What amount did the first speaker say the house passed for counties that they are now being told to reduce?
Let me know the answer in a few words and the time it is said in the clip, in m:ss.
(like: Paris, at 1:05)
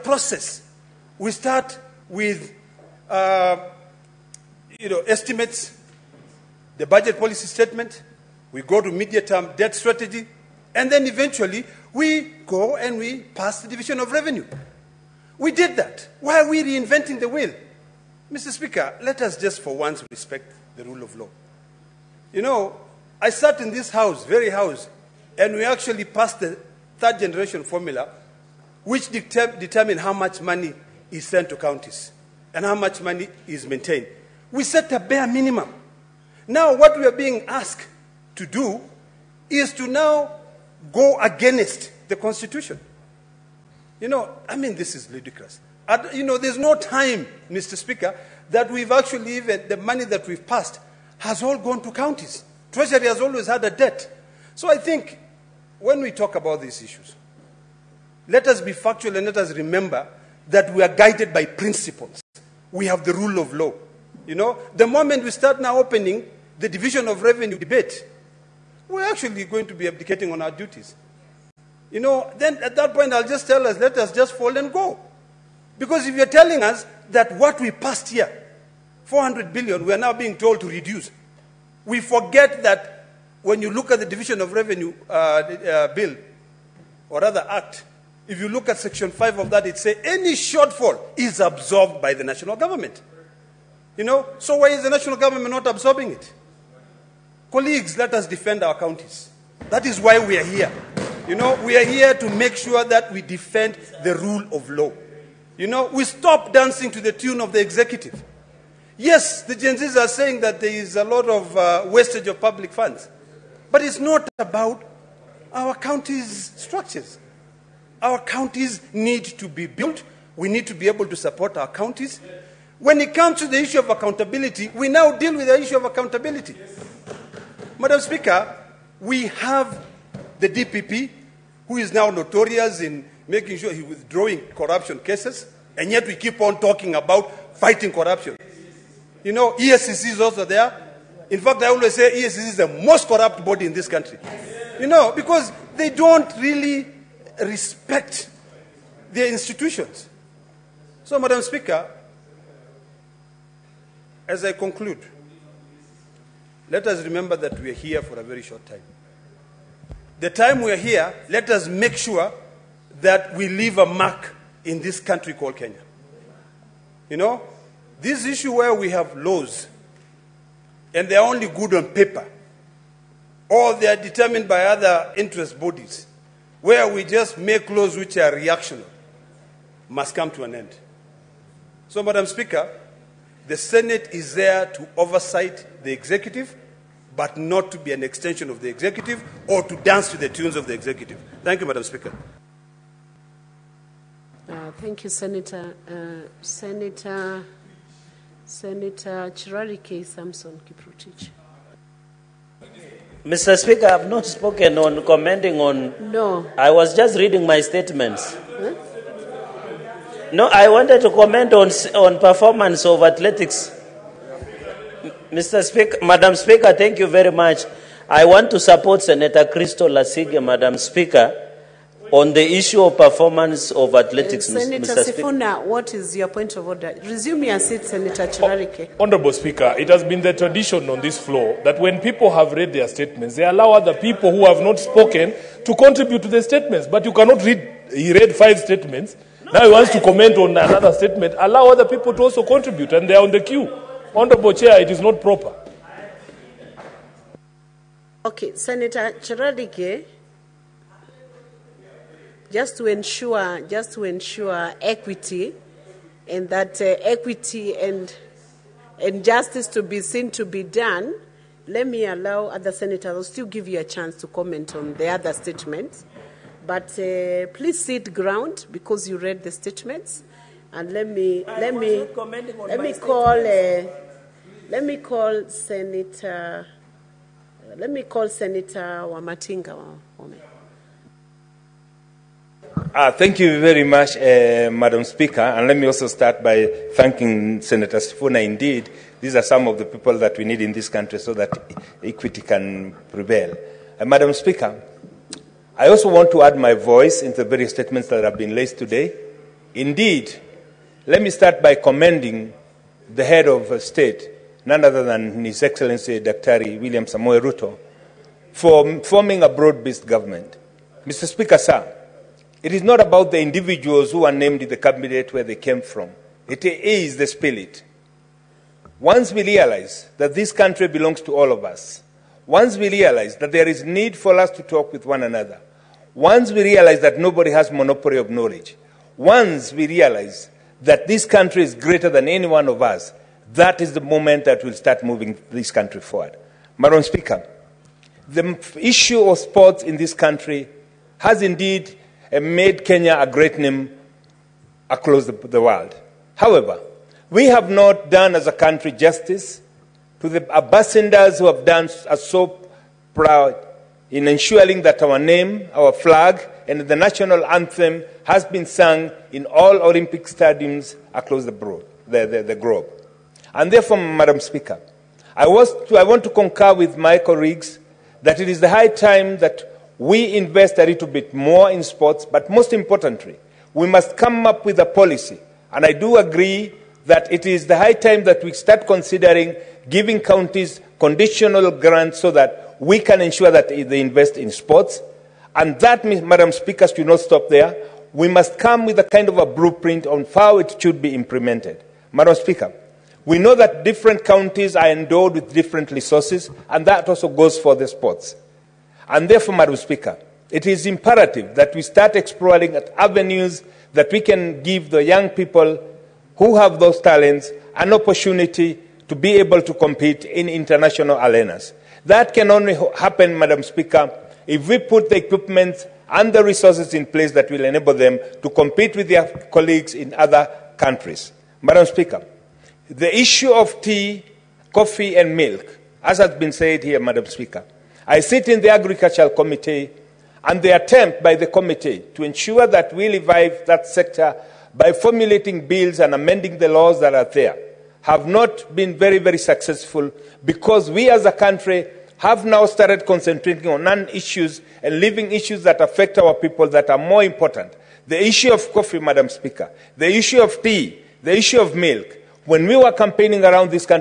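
400 billion, at 1:19.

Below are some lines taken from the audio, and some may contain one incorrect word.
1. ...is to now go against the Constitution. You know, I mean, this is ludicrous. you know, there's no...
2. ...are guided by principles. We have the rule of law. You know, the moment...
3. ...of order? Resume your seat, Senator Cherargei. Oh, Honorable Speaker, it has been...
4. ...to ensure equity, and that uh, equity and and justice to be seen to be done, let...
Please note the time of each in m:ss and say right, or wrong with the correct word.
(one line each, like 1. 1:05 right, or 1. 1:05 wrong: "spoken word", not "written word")
1. 0:39 right
2. 1:00 right
3. 3:46 right
4. 4:13 right.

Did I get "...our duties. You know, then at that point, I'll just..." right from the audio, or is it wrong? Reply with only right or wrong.
right.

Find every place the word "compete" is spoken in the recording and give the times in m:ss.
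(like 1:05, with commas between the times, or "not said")
6:49, 6:58.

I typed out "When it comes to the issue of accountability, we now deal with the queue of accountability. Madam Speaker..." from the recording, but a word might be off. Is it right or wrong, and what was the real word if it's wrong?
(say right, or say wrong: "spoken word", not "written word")
wrong: "issue", not "queue".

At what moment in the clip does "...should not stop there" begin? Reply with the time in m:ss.
6:26.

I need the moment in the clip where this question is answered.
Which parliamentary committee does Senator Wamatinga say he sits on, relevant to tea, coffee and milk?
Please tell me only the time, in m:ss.
7:08.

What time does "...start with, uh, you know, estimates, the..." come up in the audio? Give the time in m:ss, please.
0:01.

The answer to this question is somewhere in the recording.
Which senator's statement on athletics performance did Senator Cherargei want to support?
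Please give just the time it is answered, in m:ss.
3:39.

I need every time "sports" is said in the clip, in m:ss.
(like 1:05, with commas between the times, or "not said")
5:39, 6:11, 6:24, 6:37.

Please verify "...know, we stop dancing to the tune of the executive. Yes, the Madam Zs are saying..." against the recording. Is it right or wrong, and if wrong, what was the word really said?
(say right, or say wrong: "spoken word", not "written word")
wrong: "Gen", not "Madam".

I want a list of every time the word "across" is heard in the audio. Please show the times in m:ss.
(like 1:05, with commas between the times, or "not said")
5:44, 6:01.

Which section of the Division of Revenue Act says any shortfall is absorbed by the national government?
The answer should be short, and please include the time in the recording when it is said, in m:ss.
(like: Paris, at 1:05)
Section 5, at 1:28.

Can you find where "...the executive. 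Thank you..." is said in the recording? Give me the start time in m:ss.
3:10.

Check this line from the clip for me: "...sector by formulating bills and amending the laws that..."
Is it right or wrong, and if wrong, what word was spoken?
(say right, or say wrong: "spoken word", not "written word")
right.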